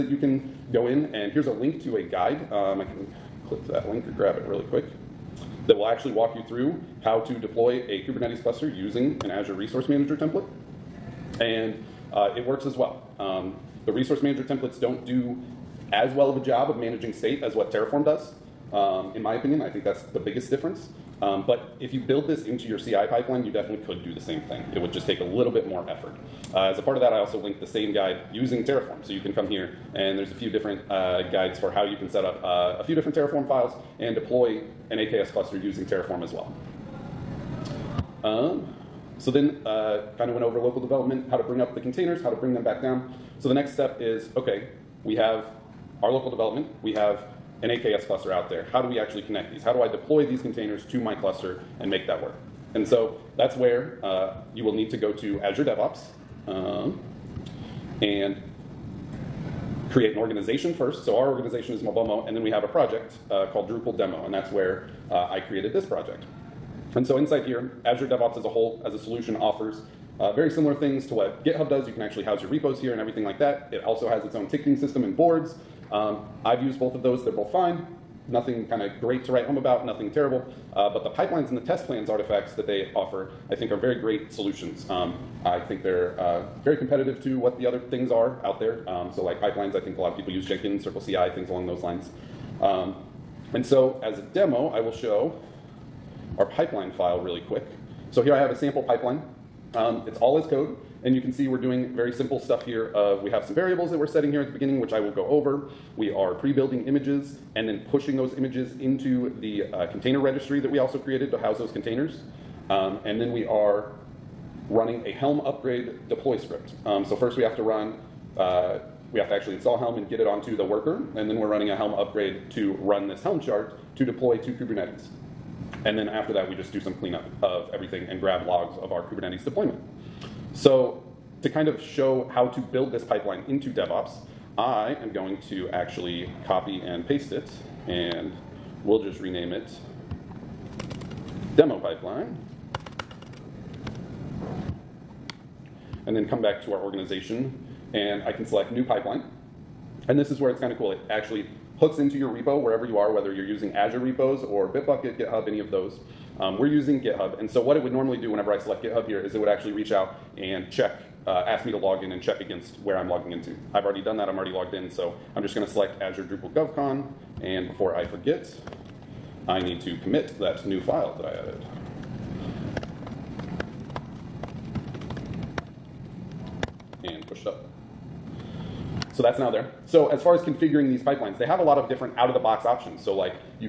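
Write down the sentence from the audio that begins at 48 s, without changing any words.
How do we actually connect these?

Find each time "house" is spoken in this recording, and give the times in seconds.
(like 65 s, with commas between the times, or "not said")
72 s, 111 s.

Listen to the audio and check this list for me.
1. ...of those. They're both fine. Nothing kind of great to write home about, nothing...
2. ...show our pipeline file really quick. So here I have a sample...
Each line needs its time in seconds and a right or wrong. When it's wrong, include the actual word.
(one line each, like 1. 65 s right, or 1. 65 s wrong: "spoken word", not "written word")
1. 76 s right
2. 94 s right.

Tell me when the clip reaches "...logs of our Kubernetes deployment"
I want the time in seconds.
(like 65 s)
128 s.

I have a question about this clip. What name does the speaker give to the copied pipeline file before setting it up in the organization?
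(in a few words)
demo pipeline.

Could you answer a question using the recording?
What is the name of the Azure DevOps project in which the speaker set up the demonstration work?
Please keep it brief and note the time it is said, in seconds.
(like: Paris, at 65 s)
Drupal Demo, at 63 s.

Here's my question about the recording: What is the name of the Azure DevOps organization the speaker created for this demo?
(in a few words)
Mobomo.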